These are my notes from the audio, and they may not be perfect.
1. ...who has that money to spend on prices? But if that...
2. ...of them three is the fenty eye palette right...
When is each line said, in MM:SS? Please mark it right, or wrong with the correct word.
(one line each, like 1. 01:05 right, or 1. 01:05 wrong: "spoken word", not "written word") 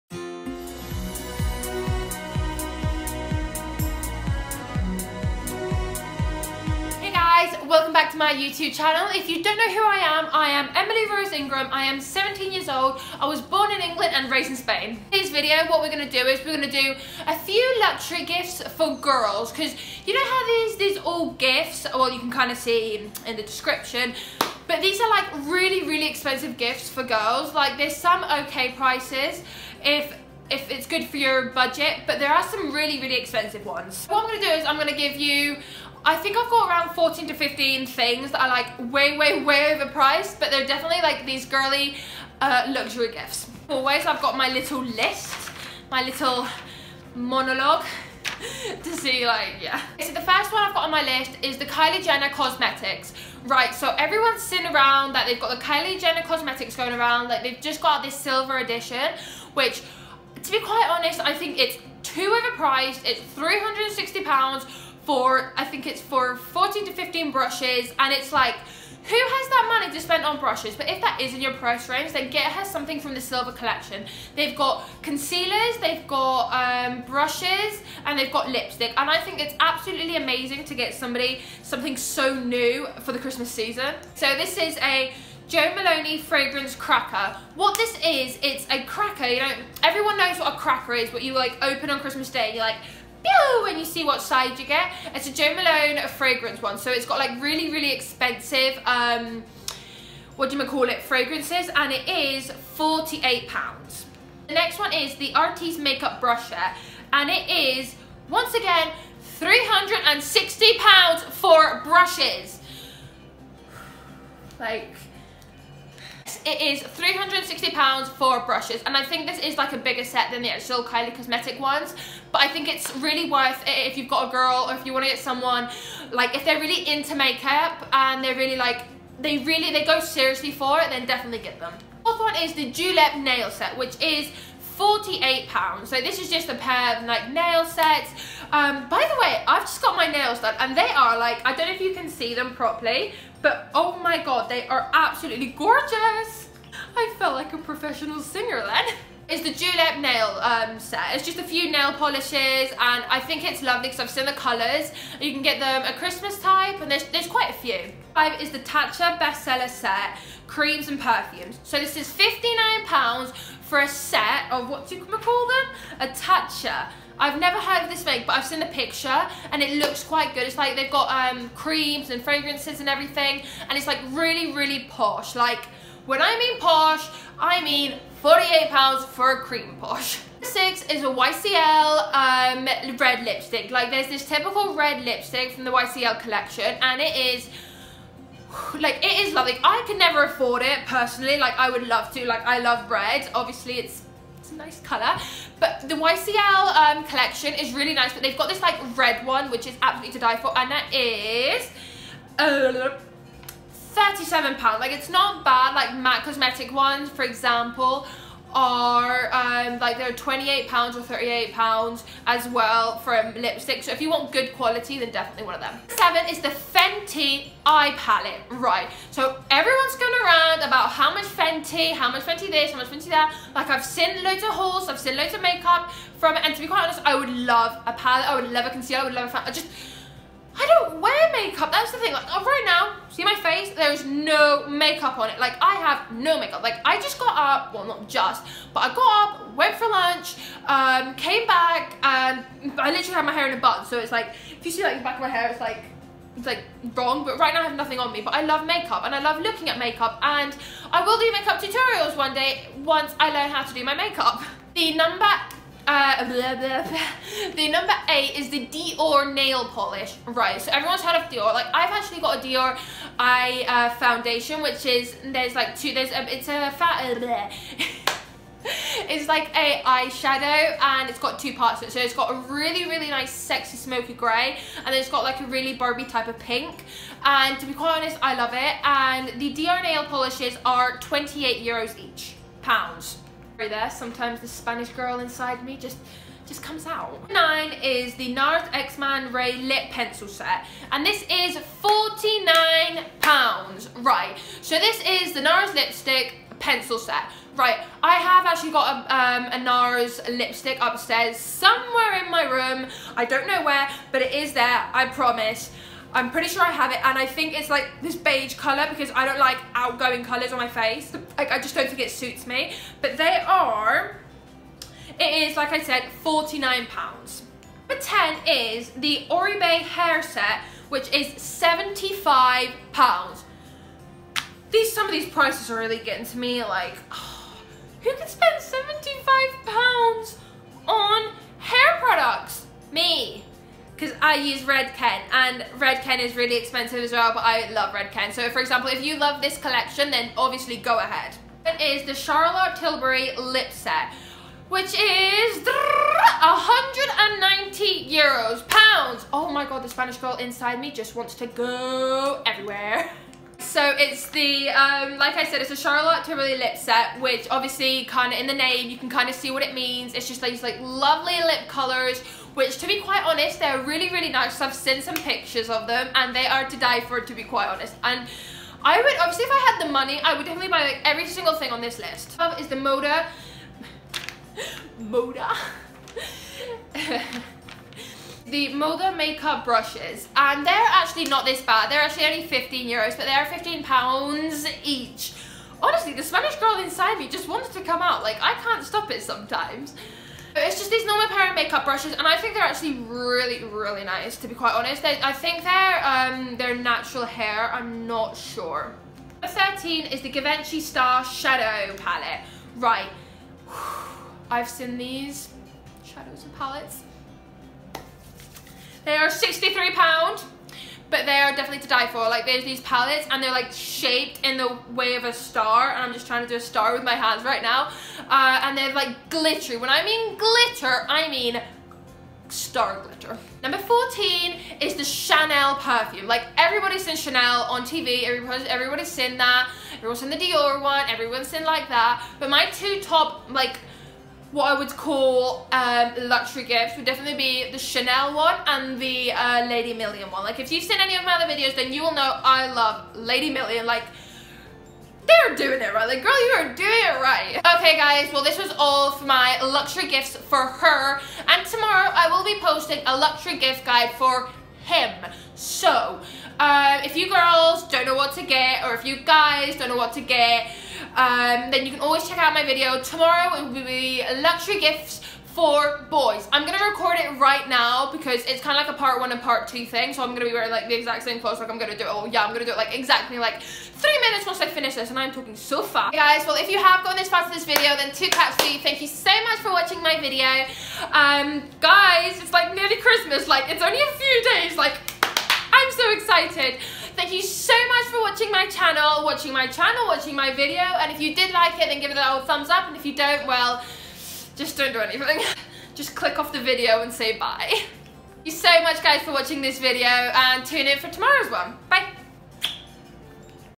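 1. 01:08 wrong: "brushes", not "prices"
2. 03:35 wrong: "seven", not "three".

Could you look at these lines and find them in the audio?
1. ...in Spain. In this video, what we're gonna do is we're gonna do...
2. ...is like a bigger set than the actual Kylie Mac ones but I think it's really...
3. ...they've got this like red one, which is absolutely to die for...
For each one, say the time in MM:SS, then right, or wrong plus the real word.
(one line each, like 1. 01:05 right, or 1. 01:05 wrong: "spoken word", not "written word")
1. 00:14 right
2. 01:59 wrong: "Cosmetic", not "Mac"
3. 03:18 right.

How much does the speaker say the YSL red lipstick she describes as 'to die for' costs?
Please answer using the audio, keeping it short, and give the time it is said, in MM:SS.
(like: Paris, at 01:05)
£37, at 03:23.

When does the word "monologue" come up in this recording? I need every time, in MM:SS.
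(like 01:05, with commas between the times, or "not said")
00:47.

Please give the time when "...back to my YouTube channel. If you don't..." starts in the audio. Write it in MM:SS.
00:07.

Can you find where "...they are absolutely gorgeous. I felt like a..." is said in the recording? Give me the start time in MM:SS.
02:24.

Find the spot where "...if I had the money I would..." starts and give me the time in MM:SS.
06:09.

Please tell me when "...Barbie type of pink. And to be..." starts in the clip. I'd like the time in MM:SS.
04:35.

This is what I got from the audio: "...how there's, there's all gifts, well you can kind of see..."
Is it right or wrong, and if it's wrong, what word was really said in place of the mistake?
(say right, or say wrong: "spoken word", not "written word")
right.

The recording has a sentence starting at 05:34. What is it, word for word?
I use Redken and Redken is really expensive as well, but I love Redken.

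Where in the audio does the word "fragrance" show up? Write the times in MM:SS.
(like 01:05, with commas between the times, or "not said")
01:26, 01:36, 01:41, 02:52.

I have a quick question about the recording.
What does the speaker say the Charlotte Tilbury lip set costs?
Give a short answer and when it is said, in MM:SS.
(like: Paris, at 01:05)
190 pounds, at 05:45.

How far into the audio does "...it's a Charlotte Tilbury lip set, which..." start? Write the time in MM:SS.
05:55.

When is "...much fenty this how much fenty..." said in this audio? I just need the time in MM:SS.
03:42.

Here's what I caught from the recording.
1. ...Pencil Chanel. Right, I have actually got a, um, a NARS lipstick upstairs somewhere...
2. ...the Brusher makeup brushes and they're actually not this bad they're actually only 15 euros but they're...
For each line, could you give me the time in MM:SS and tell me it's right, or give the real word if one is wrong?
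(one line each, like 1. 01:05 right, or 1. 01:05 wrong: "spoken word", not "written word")
1. 04:56 wrong: "Set", not "Chanel"
2. 06:18 wrong: "Moda", not "Brusher".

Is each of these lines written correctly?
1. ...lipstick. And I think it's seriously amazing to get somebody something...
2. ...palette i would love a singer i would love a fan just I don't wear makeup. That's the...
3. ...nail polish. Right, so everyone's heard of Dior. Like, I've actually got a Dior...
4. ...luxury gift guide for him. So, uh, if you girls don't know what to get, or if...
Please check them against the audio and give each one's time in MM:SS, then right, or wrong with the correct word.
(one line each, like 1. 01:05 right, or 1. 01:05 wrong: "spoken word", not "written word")
1. 01:18 wrong: "absolutely", not "seriously"
2. 03:47 wrong: "concealer", not "singer"
3. 04:19 right
4. 07:33 right.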